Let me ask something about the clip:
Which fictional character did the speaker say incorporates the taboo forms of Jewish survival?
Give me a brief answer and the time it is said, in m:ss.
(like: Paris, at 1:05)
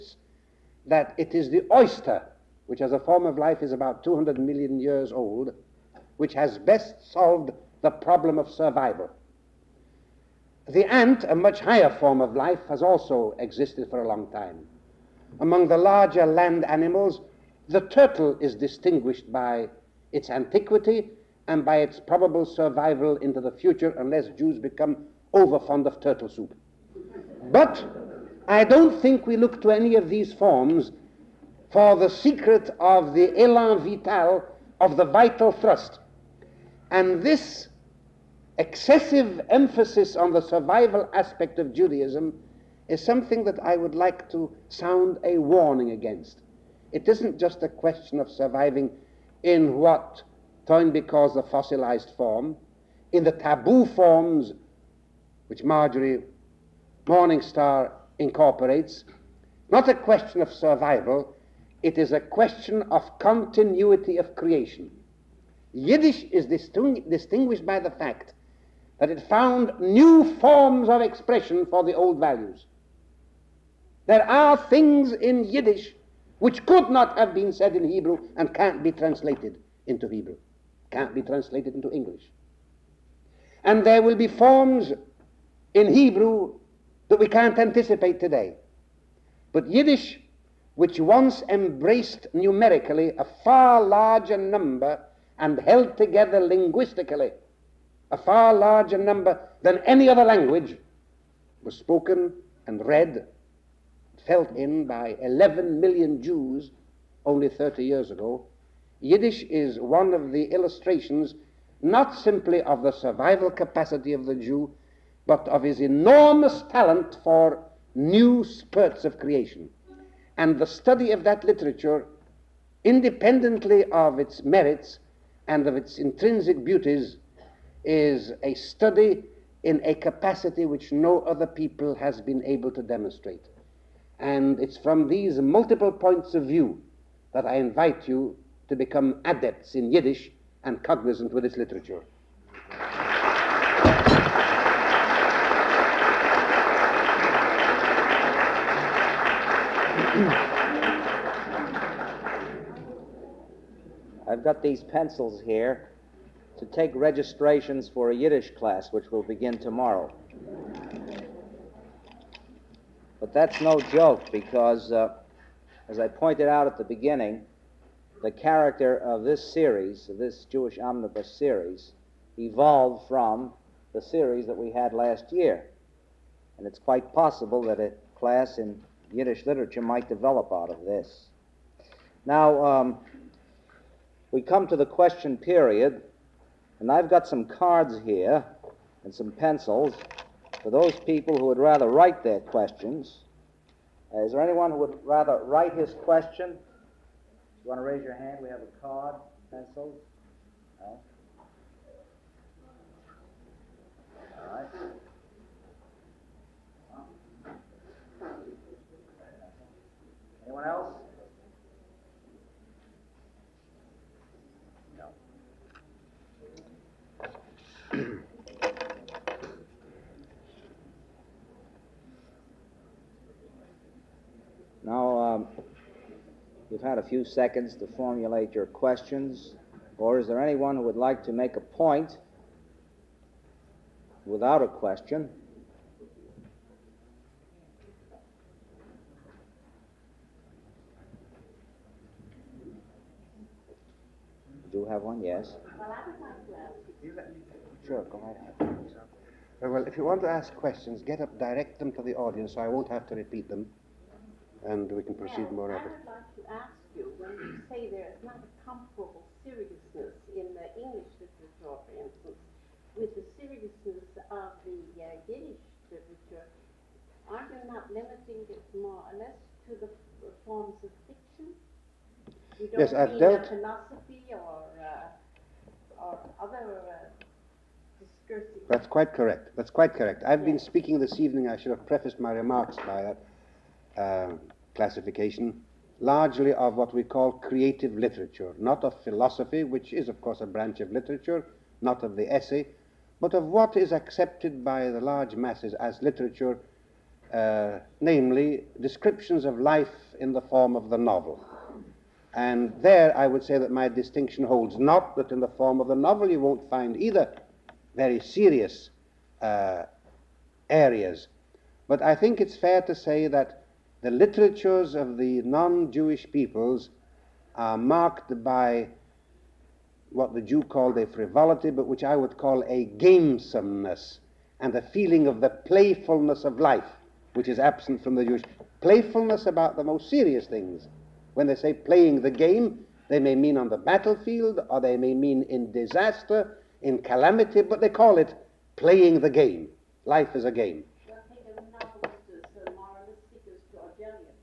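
Marjorie Morningstar, at 0:55.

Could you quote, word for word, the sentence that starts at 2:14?
And it's from these multiple points of view that I invite you to become adepts in Yiddish and cognizant with its literature.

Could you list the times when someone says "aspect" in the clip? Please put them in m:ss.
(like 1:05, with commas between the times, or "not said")
0:41.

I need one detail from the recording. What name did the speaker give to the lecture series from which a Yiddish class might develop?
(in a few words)
Jewish omnibus series.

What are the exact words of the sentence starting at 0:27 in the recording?
But I don't think we look to any of these forms for the secret of the elan vital, of the vital thrust.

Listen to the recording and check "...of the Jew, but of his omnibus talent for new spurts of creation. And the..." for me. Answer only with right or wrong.
wrong.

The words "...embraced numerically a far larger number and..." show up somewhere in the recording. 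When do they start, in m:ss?
1:31.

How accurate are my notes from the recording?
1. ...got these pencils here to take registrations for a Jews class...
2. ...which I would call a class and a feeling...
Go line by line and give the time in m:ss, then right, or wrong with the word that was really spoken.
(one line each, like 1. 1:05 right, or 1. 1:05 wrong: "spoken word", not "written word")
1. 2:34 wrong: "Yiddish", not "Jews"
2. 5:21 wrong: "gamesomeness", not "class".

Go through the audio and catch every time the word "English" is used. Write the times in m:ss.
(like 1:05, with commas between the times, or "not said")
1:21, 4:20.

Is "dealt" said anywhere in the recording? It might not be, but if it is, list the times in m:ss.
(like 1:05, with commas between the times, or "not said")
4:33.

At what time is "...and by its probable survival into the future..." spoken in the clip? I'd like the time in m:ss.
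0:21.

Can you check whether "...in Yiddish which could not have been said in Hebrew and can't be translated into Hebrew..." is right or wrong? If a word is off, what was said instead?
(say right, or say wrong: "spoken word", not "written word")
right.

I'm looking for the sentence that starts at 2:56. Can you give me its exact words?
And it's quite possible that a class in Yiddish literature might develop out of this.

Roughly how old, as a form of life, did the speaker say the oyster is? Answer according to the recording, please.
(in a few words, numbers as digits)
200 million years.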